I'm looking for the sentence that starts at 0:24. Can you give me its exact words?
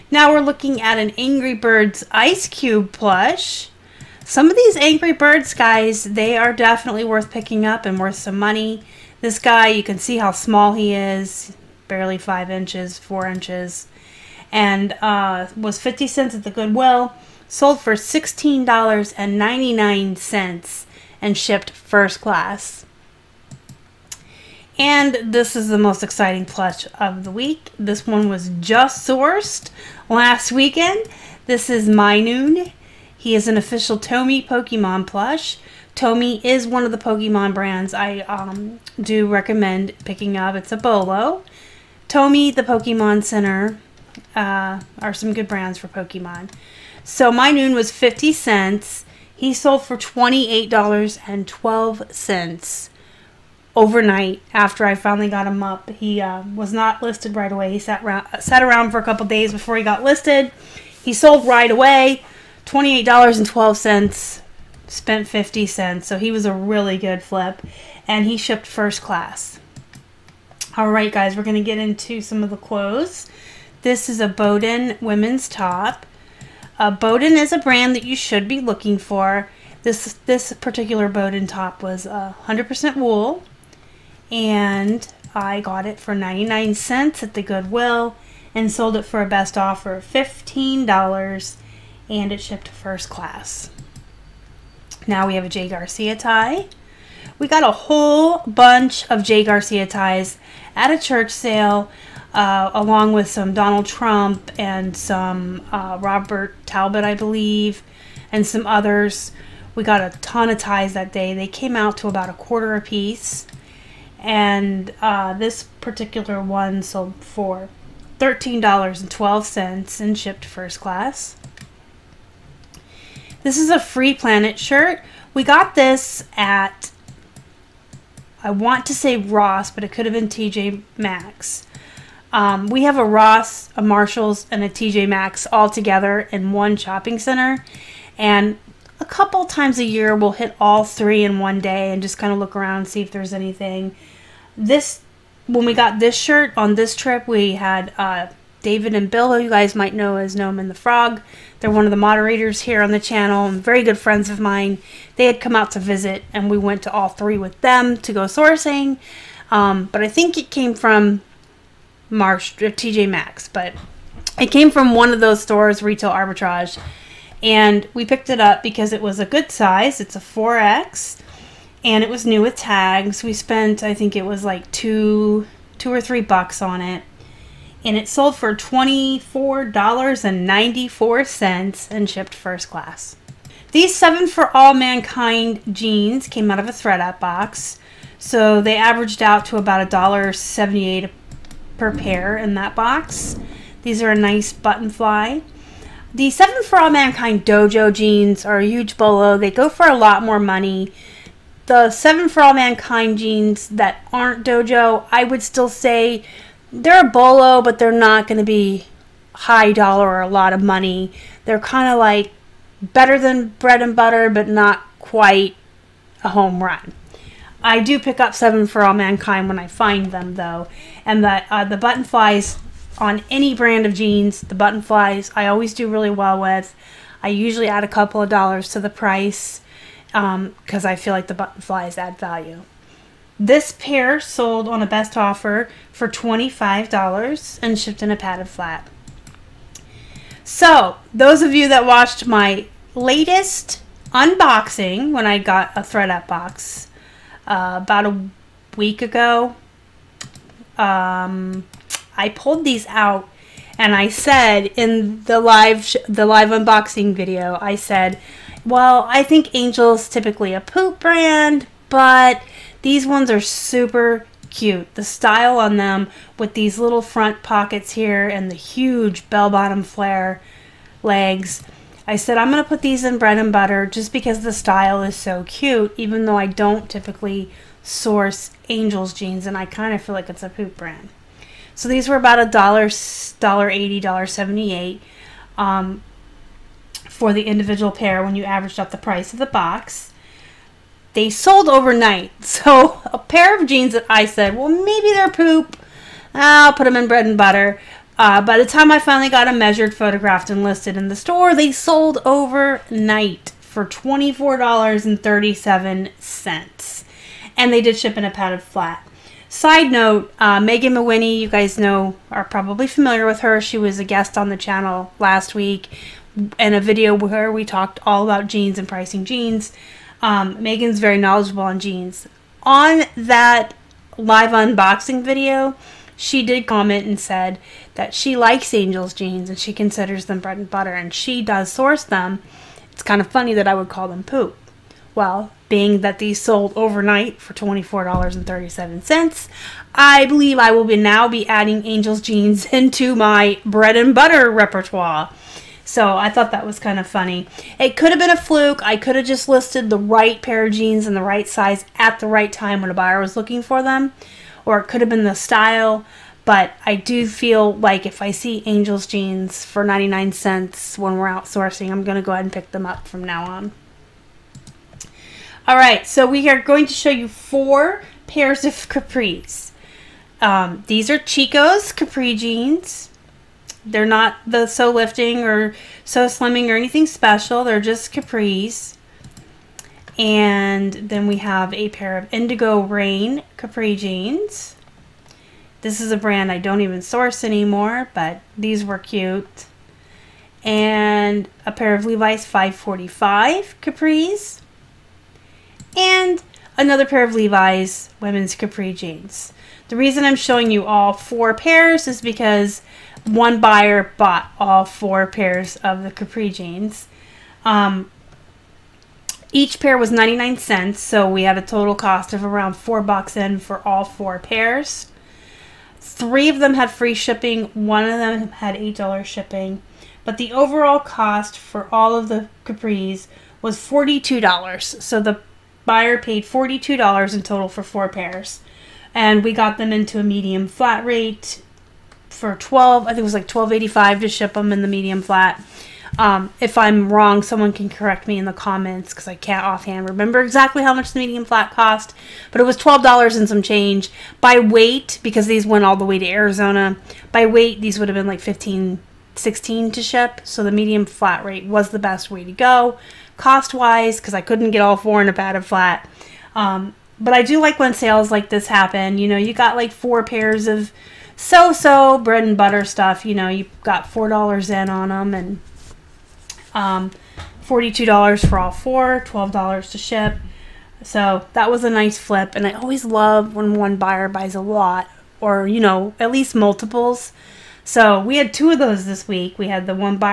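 And this is the most exciting plush of the week.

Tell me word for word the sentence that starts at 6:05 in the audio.
All right, so we are going to show you four pairs of capris.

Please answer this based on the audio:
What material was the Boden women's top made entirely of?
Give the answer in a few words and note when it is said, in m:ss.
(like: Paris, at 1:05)
wool, at 1:22.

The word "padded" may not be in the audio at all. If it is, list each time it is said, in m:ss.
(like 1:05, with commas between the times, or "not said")
3:58, 5:08.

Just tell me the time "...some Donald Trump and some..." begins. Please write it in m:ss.
1:43.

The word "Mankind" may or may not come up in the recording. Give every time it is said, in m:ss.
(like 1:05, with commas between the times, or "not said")
3:04, 3:16, 3:22, 3:38.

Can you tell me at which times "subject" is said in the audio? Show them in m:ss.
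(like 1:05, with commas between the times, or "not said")
not said.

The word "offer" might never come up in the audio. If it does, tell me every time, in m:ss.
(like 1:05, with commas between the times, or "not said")
1:29, 3:55.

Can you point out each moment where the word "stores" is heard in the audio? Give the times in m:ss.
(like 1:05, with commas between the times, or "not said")
2:45, 5:01.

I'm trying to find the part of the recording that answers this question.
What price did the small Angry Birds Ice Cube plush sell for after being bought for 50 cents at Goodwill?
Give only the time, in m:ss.
0:17.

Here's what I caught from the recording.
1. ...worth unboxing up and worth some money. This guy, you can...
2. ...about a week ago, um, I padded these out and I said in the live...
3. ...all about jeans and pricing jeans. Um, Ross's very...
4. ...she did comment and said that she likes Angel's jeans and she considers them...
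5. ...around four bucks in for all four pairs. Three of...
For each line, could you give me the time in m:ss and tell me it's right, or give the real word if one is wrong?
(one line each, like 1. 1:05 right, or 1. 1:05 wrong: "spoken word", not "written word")
1. 0:07 wrong: "picking", not "unboxing"
2. 4:07 wrong: "pulled", not "padded"
3. 5:18 wrong: "Megan", not "Ross"
4. 5:26 right
5. 6:52 right.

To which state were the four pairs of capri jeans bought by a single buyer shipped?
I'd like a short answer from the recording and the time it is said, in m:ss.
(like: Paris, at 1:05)
Arizona, at 7:26.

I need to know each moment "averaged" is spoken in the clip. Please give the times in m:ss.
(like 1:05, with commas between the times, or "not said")
3:08, 4:48.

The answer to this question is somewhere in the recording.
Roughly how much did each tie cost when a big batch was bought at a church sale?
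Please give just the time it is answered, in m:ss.
1:52.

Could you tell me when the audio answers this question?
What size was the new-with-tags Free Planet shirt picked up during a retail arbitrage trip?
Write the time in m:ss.
2:50.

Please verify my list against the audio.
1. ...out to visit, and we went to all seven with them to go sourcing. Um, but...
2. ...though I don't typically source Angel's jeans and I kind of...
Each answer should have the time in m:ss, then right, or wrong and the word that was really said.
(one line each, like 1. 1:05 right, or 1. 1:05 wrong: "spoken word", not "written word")
1. 2:35 wrong: "three", not "seven"
2. 4:36 right.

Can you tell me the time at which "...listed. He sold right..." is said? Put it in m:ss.
1:00.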